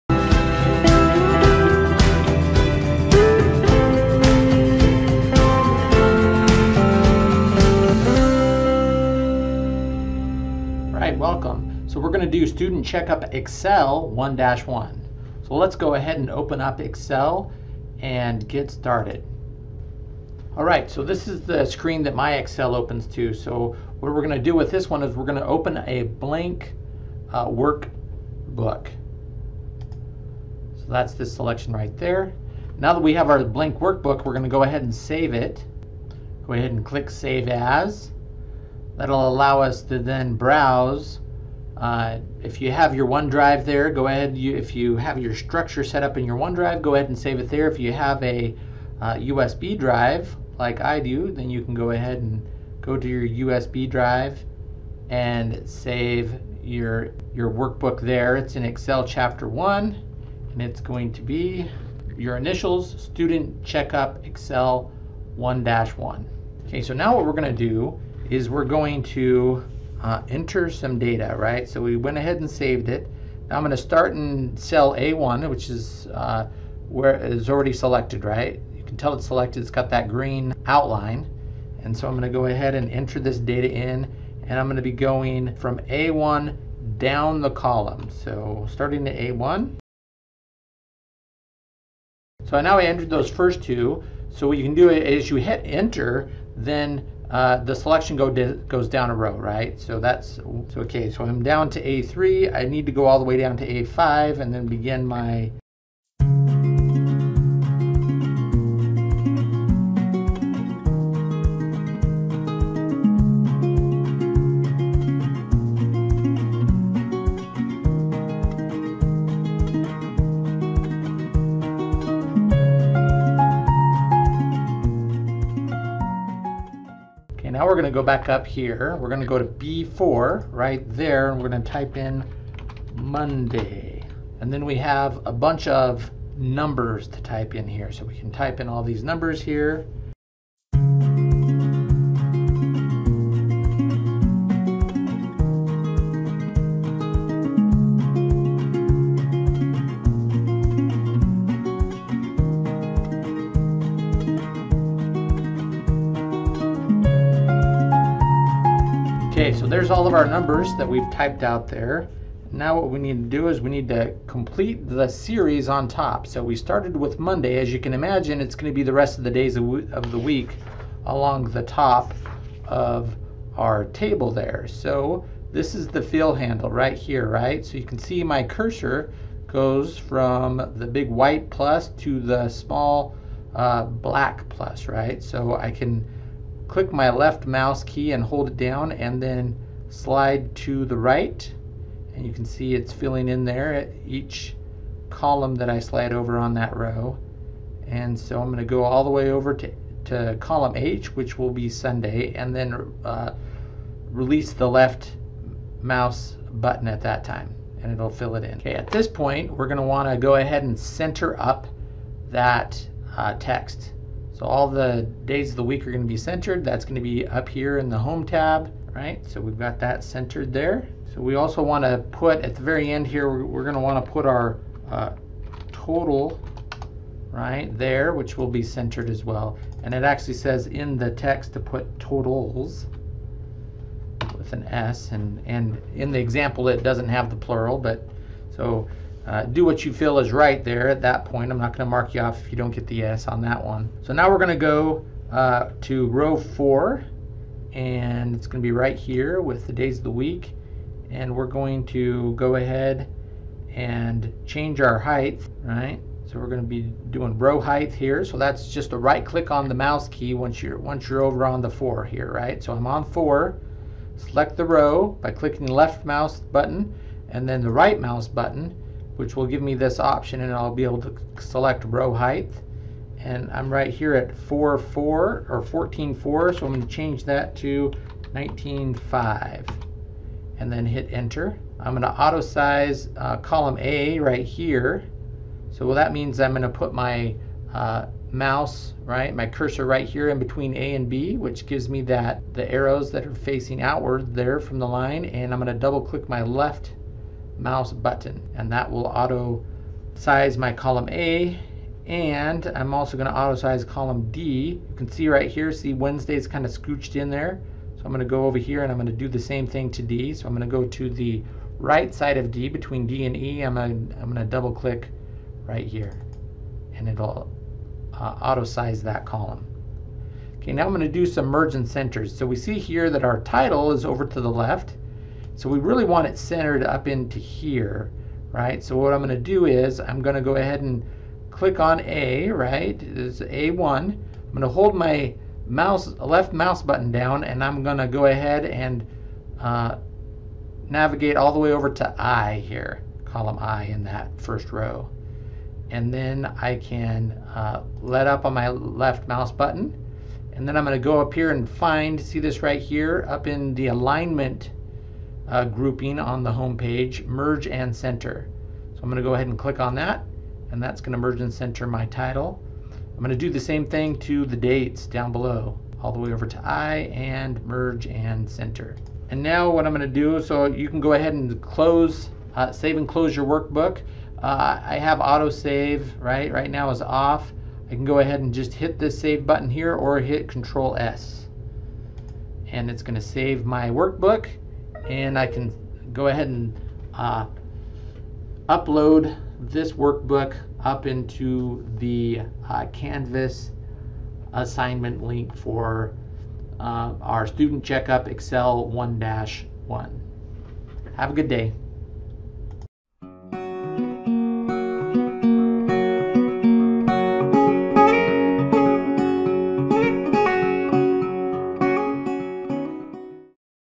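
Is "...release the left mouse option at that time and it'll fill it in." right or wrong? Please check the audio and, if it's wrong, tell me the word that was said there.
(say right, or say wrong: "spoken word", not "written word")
wrong: "button", not "option".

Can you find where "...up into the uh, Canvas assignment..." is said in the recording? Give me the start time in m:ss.
6:30.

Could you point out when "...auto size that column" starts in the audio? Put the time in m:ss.
5:18.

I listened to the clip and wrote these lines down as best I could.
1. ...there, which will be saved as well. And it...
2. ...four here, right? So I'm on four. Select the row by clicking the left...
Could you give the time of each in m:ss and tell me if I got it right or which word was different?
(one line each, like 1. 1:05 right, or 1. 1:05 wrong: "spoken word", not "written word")
1. 3:47 wrong: "centered", not "saved"
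2. 4:21 right.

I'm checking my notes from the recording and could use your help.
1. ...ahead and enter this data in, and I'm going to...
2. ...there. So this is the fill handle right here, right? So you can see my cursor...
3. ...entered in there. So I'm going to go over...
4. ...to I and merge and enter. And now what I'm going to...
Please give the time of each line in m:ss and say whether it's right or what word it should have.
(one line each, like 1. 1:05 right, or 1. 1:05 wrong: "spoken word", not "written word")
1. 1:22 right
2. 2:54 right
3. 5:06 wrong: "scooched", not "entered"
4. 6:06 wrong: "center", not "enter".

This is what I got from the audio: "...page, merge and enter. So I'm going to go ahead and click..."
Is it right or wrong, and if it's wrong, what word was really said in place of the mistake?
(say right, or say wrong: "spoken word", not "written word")
wrong: "center", not "enter".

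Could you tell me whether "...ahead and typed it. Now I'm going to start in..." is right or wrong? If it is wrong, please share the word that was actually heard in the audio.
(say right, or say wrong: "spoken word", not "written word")
wrong: "saved", not "typed".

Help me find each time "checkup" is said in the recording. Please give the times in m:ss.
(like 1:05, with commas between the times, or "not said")
0:12, 1:03, 6:37.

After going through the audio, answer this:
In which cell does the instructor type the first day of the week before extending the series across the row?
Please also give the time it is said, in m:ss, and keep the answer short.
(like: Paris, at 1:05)
B4, at 2:09.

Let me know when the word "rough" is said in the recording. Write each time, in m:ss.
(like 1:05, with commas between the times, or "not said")
not said.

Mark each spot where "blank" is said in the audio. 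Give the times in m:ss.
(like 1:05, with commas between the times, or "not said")
0:26, 0:33.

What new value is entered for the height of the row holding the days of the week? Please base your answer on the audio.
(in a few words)
19.5.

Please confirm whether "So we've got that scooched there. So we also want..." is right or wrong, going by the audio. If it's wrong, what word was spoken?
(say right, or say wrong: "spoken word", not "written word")
wrong: "centered", not "scooched".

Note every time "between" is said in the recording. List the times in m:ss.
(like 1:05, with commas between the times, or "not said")
4:50, 5:12.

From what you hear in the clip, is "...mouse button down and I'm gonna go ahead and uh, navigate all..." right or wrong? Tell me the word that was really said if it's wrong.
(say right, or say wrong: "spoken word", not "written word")
right.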